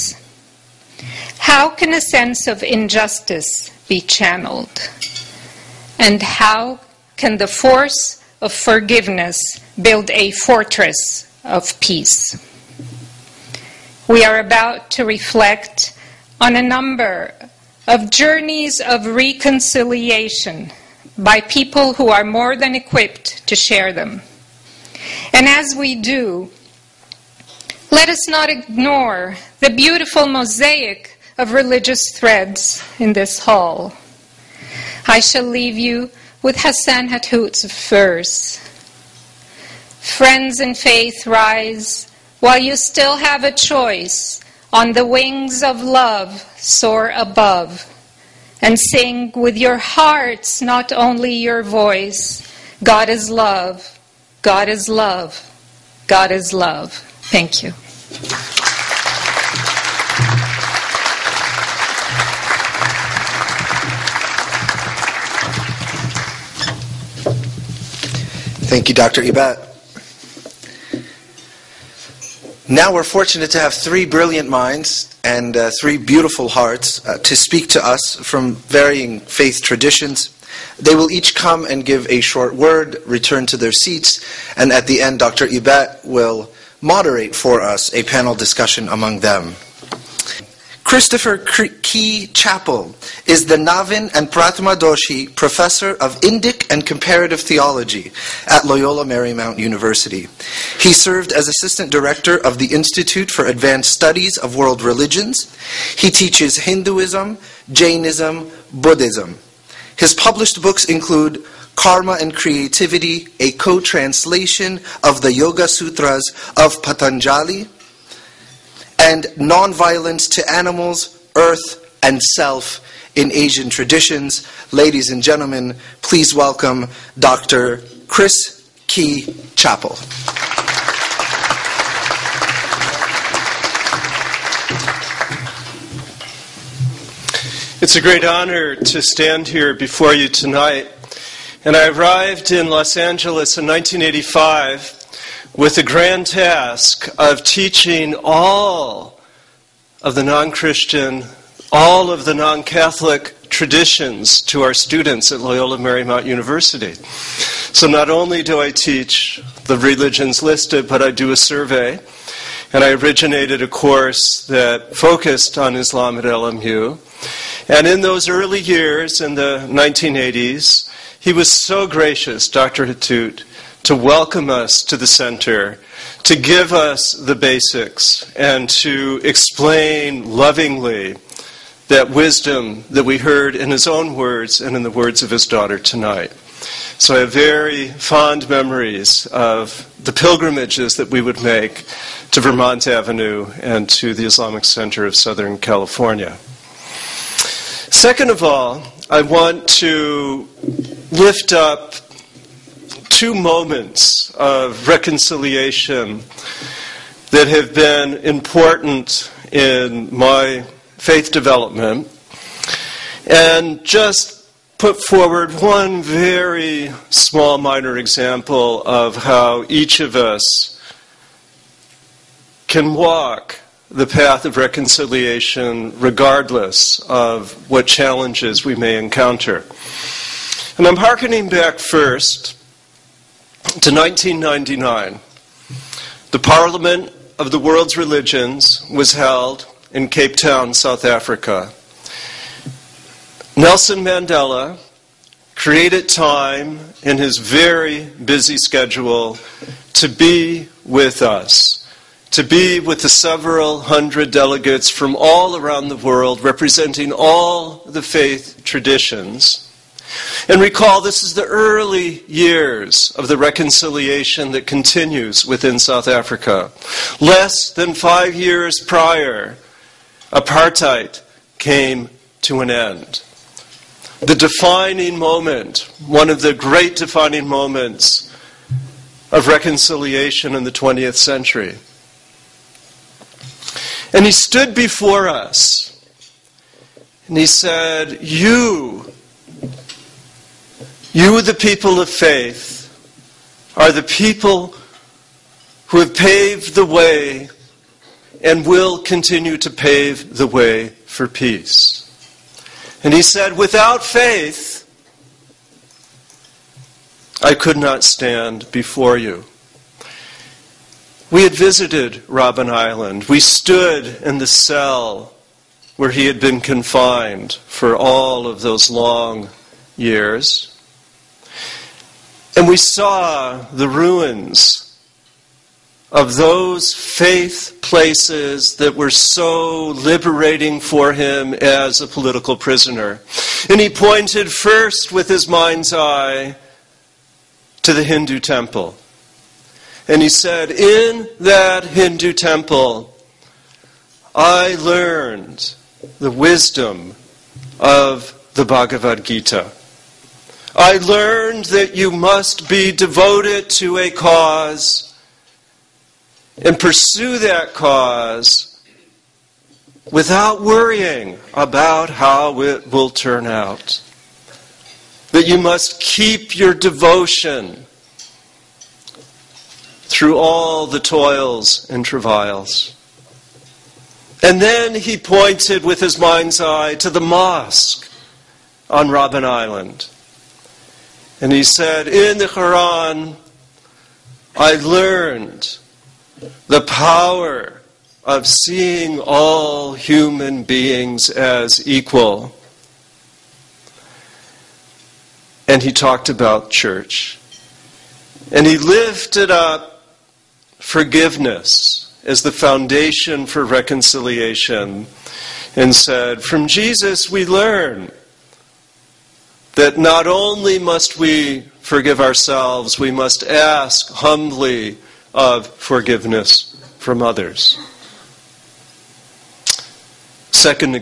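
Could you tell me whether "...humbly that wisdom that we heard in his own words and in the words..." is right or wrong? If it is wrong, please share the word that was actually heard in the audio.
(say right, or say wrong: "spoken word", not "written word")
wrong: "lovingly", not "humbly".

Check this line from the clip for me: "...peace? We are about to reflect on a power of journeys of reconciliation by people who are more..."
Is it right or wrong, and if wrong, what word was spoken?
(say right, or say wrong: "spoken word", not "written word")
wrong: "number", not "power".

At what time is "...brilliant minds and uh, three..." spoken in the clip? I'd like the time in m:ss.
1:14.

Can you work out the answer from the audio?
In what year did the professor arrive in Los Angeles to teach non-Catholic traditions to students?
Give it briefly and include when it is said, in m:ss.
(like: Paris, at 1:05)
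1985, at 2:23.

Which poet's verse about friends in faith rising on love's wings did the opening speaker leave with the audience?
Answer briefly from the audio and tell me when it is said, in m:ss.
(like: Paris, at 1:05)
Hassan Hathout, at 0:36.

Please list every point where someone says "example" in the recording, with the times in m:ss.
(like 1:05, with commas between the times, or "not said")
3:37.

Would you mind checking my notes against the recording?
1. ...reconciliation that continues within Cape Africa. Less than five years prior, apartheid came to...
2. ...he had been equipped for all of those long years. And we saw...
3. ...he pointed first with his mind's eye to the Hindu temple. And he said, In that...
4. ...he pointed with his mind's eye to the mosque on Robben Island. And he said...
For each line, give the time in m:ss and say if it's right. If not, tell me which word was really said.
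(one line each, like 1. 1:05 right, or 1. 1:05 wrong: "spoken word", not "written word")
1. 4:23 wrong: "South", not "Cape"
2. 5:16 wrong: "confined", not "equipped"
3. 5:33 right
4. 6:14 right.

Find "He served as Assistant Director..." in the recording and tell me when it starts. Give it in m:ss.
1:40.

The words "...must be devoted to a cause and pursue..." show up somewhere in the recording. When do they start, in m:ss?
5:52.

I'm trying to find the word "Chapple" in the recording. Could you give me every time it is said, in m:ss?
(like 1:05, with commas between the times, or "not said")
1:32, 2:09.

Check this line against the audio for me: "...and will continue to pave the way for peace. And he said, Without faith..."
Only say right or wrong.
right.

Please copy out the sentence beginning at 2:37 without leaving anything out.
So not only do I teach the religions listed, but I do a survey.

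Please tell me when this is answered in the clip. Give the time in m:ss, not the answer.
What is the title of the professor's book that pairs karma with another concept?
1:51.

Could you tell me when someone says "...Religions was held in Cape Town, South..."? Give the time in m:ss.
3:57.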